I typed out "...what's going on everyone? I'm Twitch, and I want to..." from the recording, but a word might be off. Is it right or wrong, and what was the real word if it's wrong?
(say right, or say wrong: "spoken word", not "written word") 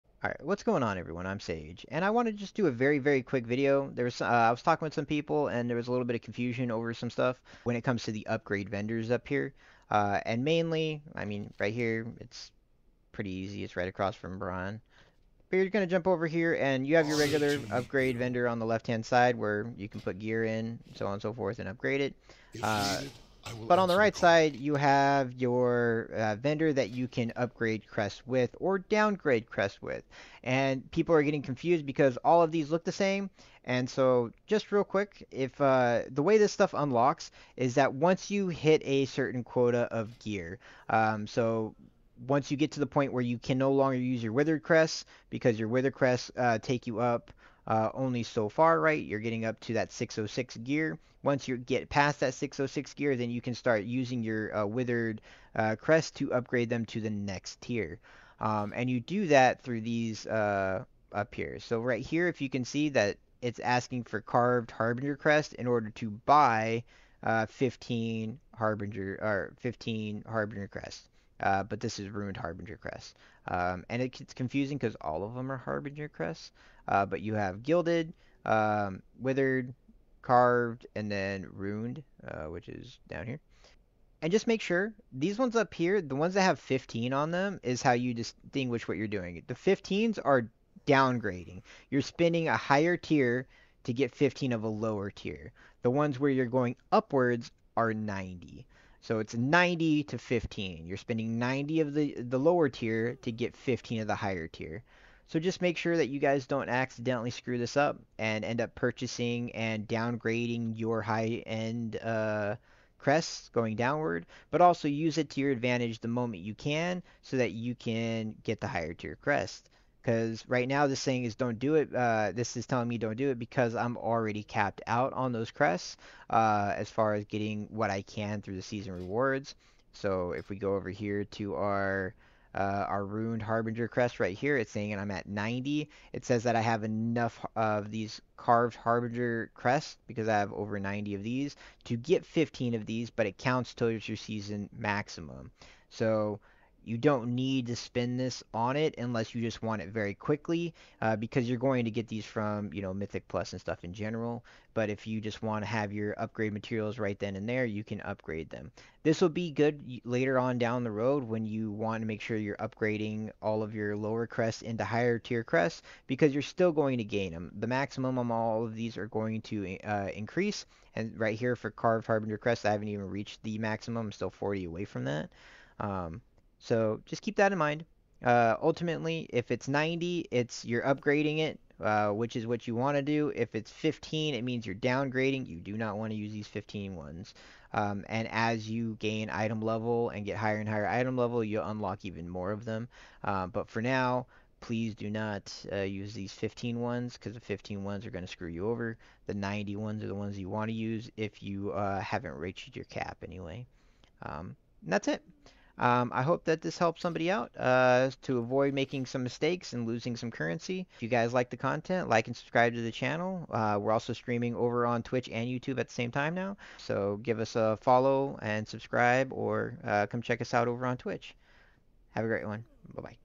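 wrong: "Sage", not "Twitch".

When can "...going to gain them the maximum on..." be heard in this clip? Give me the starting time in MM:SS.
02:46.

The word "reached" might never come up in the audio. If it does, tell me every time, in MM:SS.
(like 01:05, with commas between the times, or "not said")
02:53, 03:22.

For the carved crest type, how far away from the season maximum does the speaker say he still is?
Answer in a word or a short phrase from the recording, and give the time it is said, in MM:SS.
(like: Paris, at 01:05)
40, at 02:54.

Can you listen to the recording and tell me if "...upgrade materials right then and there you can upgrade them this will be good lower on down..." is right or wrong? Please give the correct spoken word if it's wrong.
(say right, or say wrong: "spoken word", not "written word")
wrong: "later", not "lower".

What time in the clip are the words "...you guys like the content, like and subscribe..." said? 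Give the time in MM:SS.
03:31.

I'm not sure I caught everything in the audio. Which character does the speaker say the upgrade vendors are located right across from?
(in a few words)
Brian.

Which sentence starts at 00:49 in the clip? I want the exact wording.
You're getting up to that 606 gear.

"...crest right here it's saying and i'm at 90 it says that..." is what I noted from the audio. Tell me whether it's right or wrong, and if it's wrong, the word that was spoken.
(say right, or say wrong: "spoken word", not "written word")
right.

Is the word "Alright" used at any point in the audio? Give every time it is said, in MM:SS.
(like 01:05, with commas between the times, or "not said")
00:00.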